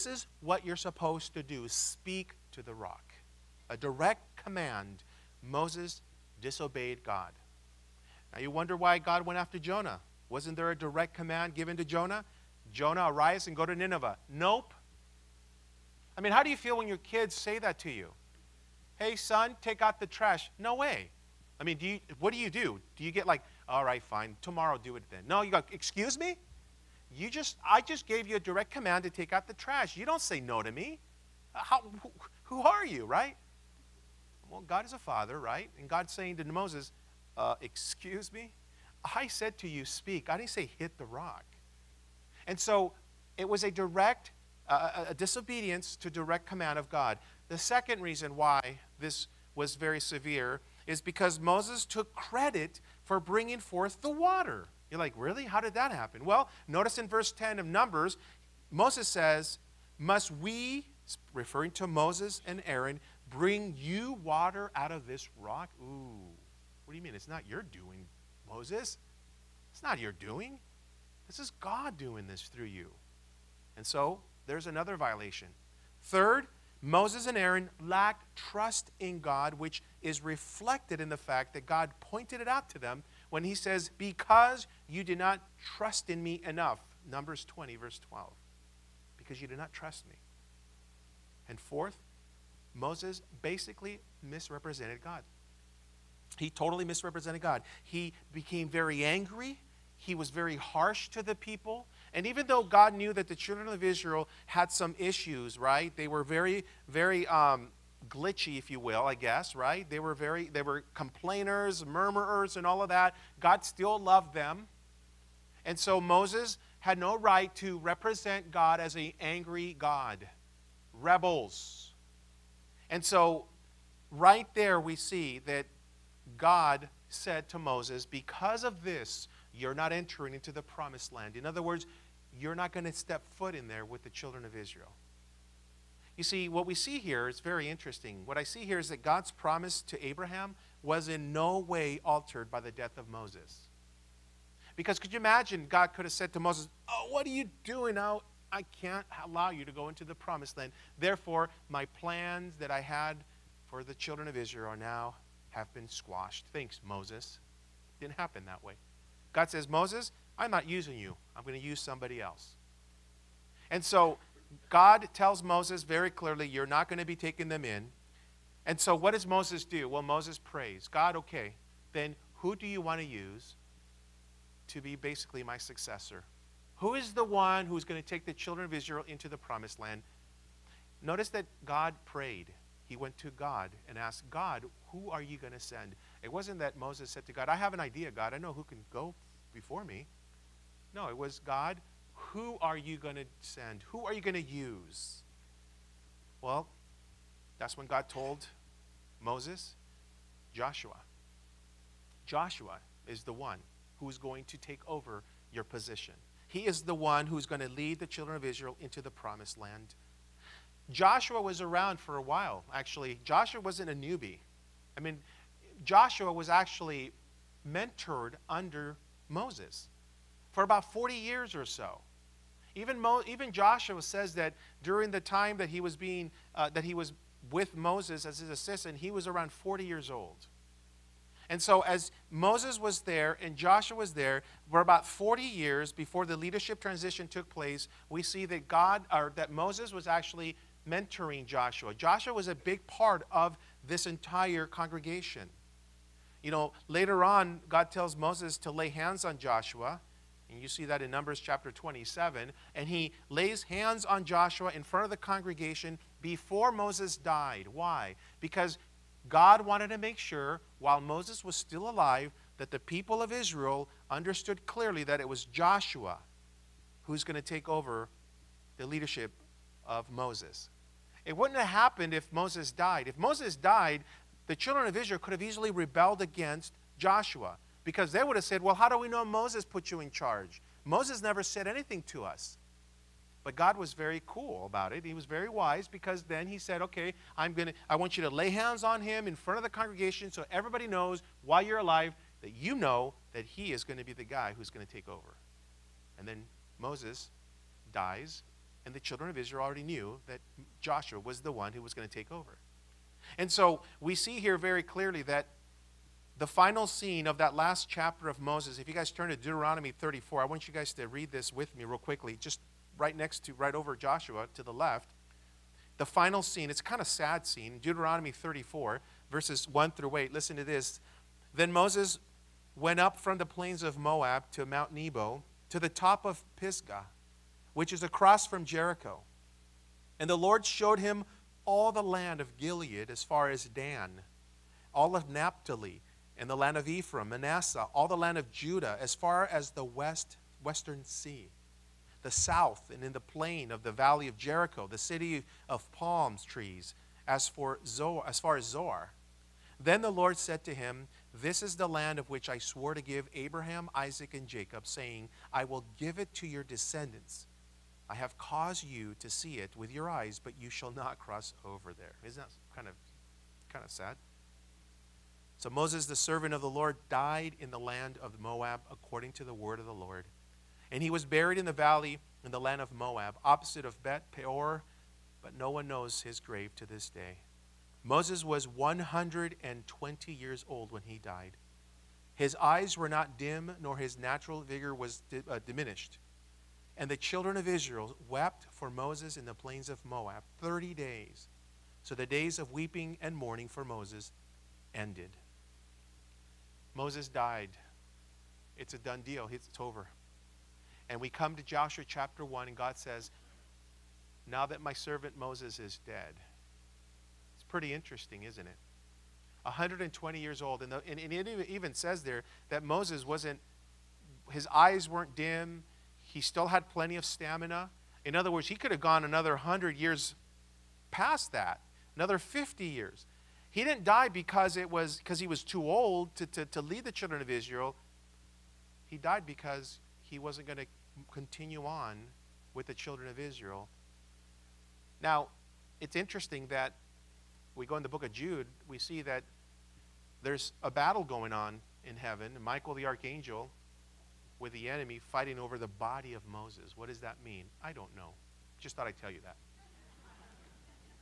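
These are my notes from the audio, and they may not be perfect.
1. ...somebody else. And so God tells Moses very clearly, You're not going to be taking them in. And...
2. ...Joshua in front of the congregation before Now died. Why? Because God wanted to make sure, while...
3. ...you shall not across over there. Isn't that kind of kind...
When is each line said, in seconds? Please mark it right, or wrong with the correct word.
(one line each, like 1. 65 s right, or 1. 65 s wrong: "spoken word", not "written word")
1. 161 s right
2. 254 s wrong: "Moses", not "Now"
3. 360 s wrong: "cross", not "across".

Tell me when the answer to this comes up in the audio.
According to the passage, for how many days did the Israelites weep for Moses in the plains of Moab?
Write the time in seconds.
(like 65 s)
390 s.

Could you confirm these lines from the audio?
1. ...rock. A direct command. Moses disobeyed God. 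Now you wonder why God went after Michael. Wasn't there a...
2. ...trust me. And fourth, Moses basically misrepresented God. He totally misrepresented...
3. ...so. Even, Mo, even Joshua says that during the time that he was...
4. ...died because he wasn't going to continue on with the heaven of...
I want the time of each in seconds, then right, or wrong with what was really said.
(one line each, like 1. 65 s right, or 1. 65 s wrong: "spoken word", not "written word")
1. 2 s wrong: "Jonah", not "Michael"
2. 89 s right
3. 221 s right
4. 429 s wrong: "children", not "heaven".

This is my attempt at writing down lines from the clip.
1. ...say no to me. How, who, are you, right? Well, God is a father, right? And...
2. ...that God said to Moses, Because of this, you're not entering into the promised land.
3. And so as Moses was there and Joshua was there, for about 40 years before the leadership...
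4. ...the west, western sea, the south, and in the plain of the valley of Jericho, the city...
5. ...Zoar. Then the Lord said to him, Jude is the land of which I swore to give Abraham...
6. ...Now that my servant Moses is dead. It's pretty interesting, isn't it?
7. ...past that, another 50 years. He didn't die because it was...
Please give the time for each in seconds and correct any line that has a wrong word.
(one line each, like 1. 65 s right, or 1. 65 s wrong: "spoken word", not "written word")
1. 30 s right
2. 125 s right
3. 231 s right
4. 339 s right
5. 348 s wrong: "This", not "Jude"
6. 404 s right
7. 421 s right.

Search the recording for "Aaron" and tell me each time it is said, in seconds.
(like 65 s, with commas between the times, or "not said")
62 s, 77 s.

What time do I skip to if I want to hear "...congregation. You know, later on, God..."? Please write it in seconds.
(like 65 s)
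244 s.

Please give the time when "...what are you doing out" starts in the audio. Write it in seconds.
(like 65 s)
147 s.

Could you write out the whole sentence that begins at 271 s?
It wouldn't have happened if Moses died.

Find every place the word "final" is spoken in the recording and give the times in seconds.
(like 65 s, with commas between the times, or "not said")
306 s, 316 s.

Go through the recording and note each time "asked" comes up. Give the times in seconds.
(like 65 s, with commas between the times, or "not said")
183 s.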